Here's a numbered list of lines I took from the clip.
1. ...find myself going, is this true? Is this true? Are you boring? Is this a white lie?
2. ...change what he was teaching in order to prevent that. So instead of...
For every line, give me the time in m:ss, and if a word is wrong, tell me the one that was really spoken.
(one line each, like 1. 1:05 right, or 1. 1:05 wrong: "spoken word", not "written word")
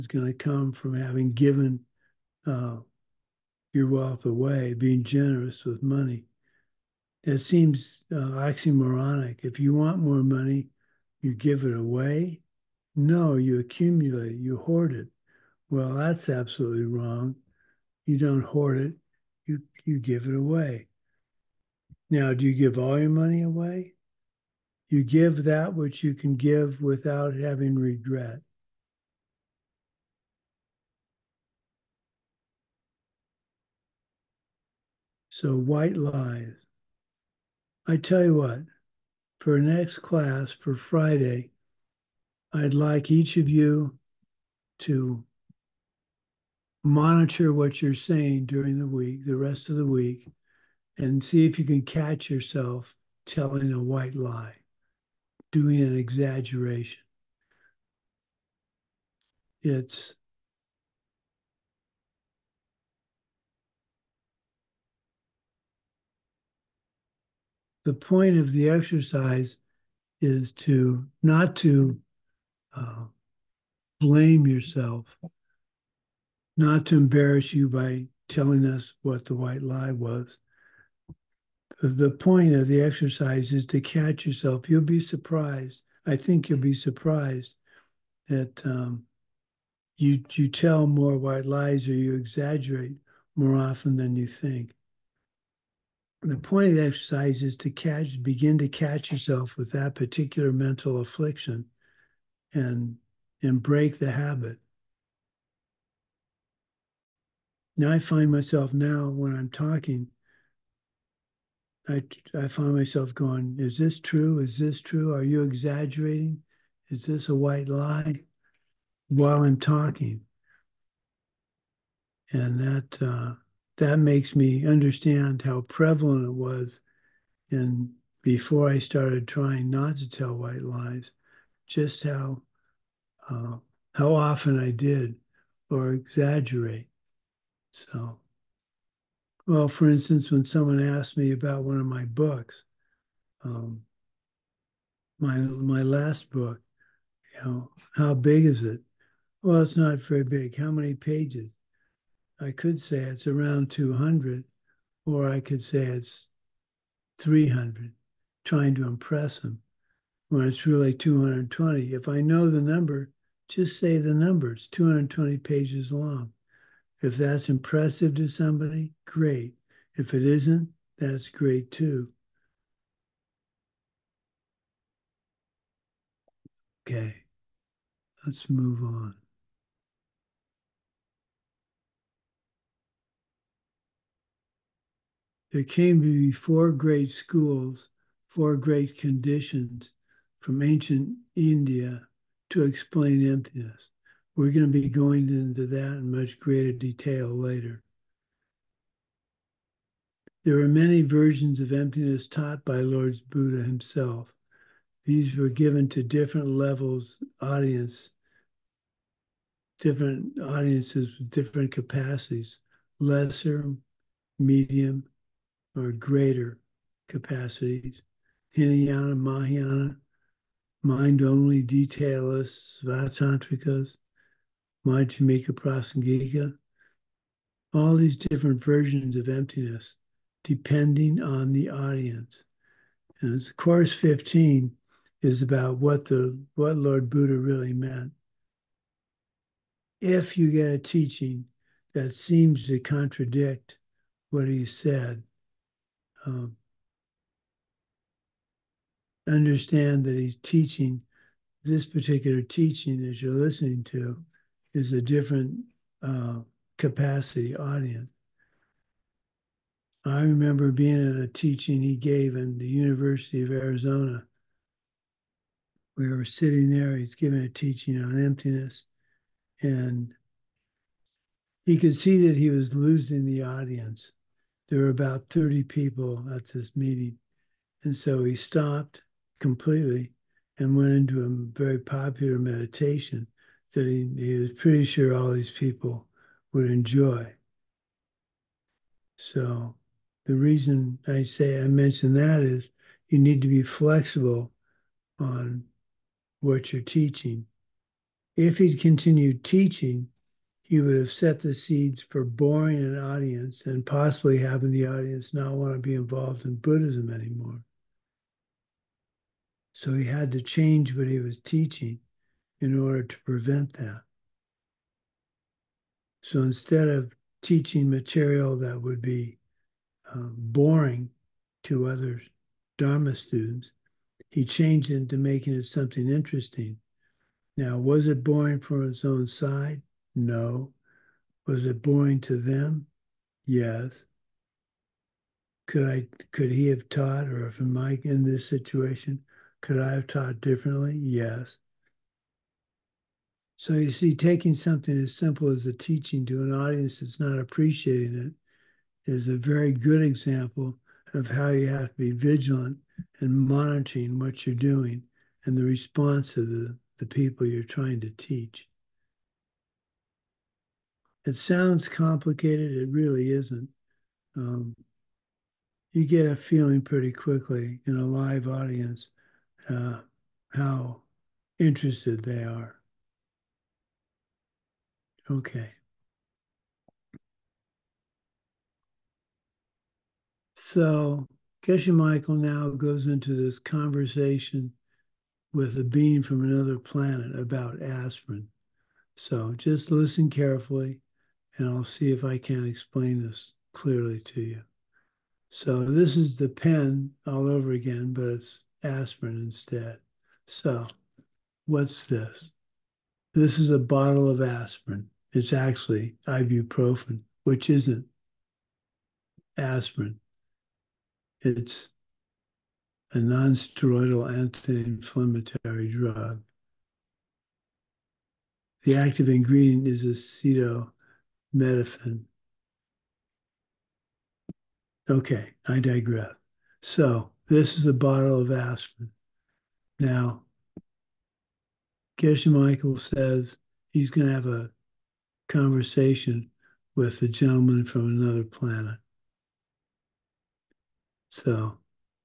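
1. 1:52 wrong: "exaggerating", not "boring"
2. 5:10 right.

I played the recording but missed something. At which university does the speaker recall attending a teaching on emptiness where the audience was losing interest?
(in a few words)
University of Arizona.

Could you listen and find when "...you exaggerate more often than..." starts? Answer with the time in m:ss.
1:31.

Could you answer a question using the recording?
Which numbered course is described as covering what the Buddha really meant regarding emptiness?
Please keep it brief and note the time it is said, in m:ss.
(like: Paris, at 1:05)
Course 15, at 3:53.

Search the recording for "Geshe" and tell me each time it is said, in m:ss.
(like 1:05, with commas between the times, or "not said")
6:21, 7:12.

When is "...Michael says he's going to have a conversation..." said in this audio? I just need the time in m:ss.
7:12.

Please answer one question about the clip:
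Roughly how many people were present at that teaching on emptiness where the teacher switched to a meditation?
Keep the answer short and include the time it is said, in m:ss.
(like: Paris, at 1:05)
30, at 4:35.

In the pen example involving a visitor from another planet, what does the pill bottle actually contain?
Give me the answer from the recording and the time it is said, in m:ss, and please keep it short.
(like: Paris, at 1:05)
Ibuprofen, at 6:46.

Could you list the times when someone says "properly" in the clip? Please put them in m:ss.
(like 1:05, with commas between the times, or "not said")
not said.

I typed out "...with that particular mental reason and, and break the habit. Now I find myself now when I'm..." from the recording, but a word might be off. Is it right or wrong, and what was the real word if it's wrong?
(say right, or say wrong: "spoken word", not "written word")
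wrong: "affliction", not "reason".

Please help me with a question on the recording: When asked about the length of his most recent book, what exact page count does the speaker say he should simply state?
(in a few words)
220.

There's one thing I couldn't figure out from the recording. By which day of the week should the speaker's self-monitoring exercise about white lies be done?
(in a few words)
Friday.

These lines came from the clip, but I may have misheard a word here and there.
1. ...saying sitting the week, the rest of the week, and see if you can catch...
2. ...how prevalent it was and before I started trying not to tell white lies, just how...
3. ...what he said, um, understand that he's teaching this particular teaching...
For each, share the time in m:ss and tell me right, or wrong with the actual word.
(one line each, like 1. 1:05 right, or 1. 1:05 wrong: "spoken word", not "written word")
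1. 0:47 wrong: "during", not "sitting"
2. 2:05 right
3. 4:04 right.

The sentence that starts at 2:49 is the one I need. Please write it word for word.
If it isn't, that's great too.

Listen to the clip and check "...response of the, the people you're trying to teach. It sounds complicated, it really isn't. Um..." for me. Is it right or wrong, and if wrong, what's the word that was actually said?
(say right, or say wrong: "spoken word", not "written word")
right.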